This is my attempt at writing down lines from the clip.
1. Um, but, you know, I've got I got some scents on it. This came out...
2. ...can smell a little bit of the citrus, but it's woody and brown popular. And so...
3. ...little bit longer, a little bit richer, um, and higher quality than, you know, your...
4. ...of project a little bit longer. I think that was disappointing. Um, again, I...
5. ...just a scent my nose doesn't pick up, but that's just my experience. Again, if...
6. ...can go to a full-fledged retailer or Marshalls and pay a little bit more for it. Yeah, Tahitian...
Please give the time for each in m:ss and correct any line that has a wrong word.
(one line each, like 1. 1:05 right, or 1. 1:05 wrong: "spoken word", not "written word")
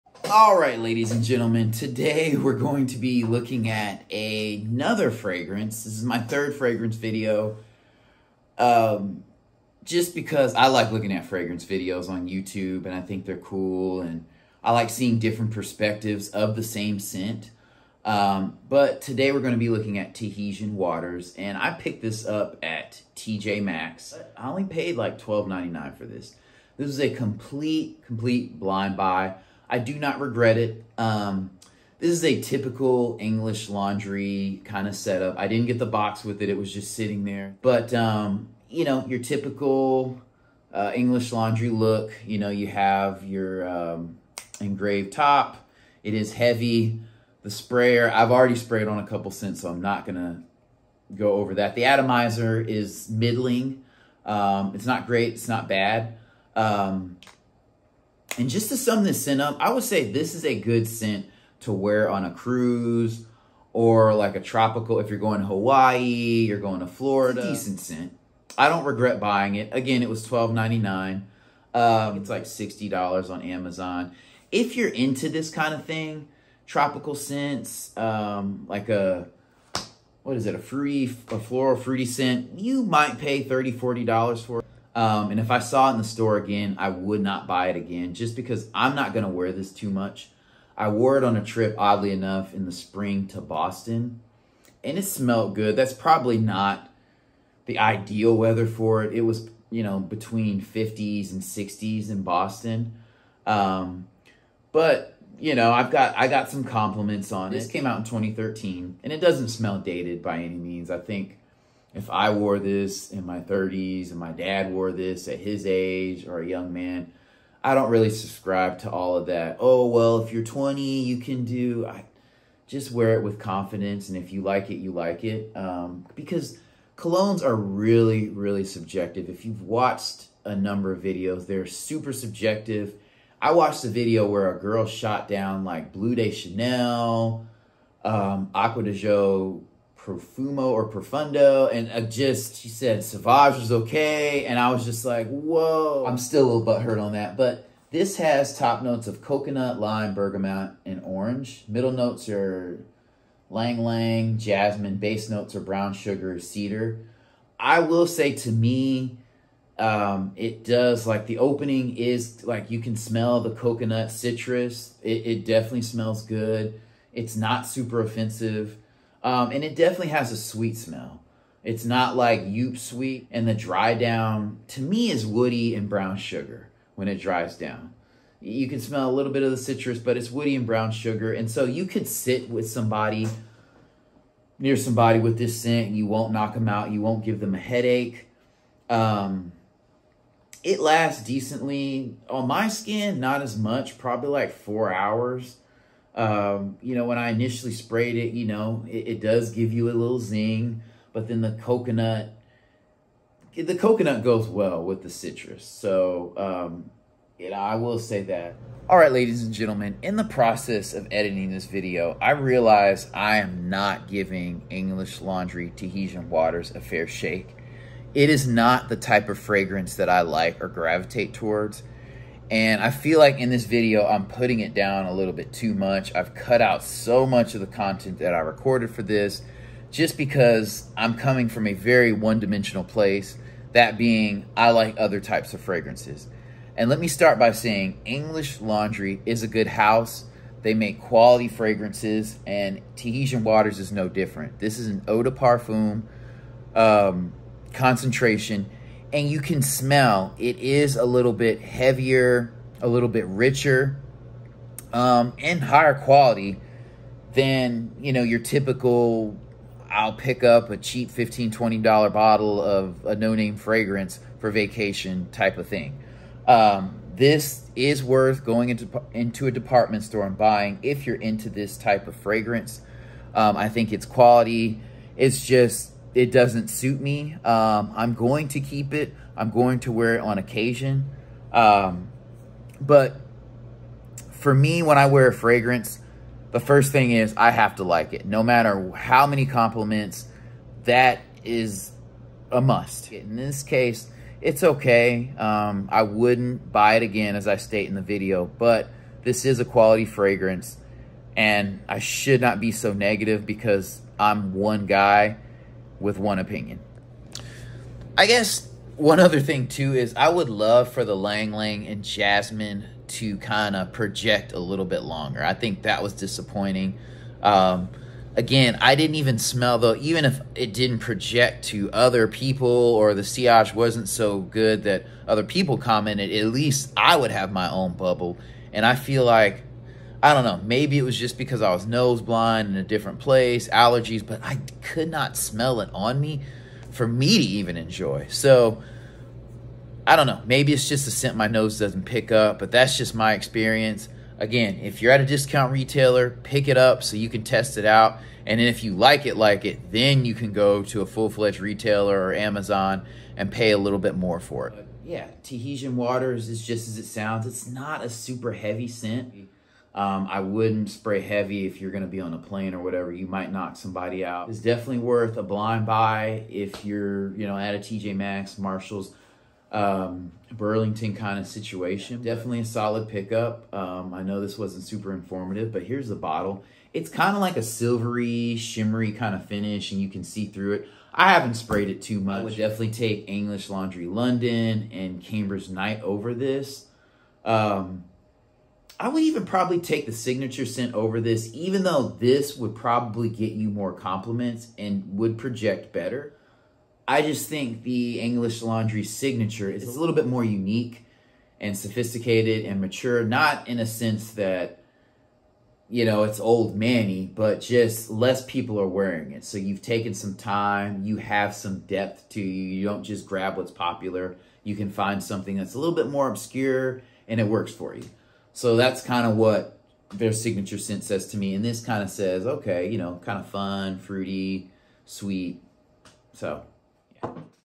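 1. 1:43 wrong: "compliments", not "scents"
2. 2:58 wrong: "sugar", not "popular"
3. 4:11 wrong: "heavier", not "longer"
4. 5:13 right
5. 5:40 right
6. 5:50 wrong: "Amazon", not "Marshalls".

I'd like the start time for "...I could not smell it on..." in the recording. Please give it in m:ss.
5:34.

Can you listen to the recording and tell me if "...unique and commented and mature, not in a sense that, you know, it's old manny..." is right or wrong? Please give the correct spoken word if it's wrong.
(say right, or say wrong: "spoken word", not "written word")
wrong: "sophisticated", not "commented".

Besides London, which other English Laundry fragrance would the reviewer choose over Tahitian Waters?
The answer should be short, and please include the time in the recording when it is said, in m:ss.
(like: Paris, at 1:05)
Cambridge Night, at 6:25.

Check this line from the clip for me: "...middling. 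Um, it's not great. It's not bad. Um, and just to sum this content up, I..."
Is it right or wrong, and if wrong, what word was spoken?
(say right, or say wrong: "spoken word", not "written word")
wrong: "scent", not "content".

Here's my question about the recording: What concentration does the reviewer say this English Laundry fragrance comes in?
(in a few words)
Eau de parfum.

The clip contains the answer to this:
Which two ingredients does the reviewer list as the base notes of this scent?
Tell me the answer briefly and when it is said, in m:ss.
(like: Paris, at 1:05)
Brown sugar, cedar, at 2:35.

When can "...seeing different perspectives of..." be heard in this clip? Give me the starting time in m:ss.
0:14.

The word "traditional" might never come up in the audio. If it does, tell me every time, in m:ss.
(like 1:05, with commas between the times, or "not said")
not said.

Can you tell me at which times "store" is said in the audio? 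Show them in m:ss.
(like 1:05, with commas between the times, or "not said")
1:26, 4:30.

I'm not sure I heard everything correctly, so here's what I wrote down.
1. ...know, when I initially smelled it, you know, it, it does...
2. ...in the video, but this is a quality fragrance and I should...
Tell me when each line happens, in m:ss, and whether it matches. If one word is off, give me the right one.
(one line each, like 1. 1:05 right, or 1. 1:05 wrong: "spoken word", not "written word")
1. 3:16 wrong: "sprayed", not "smelled"
2. 4:57 right.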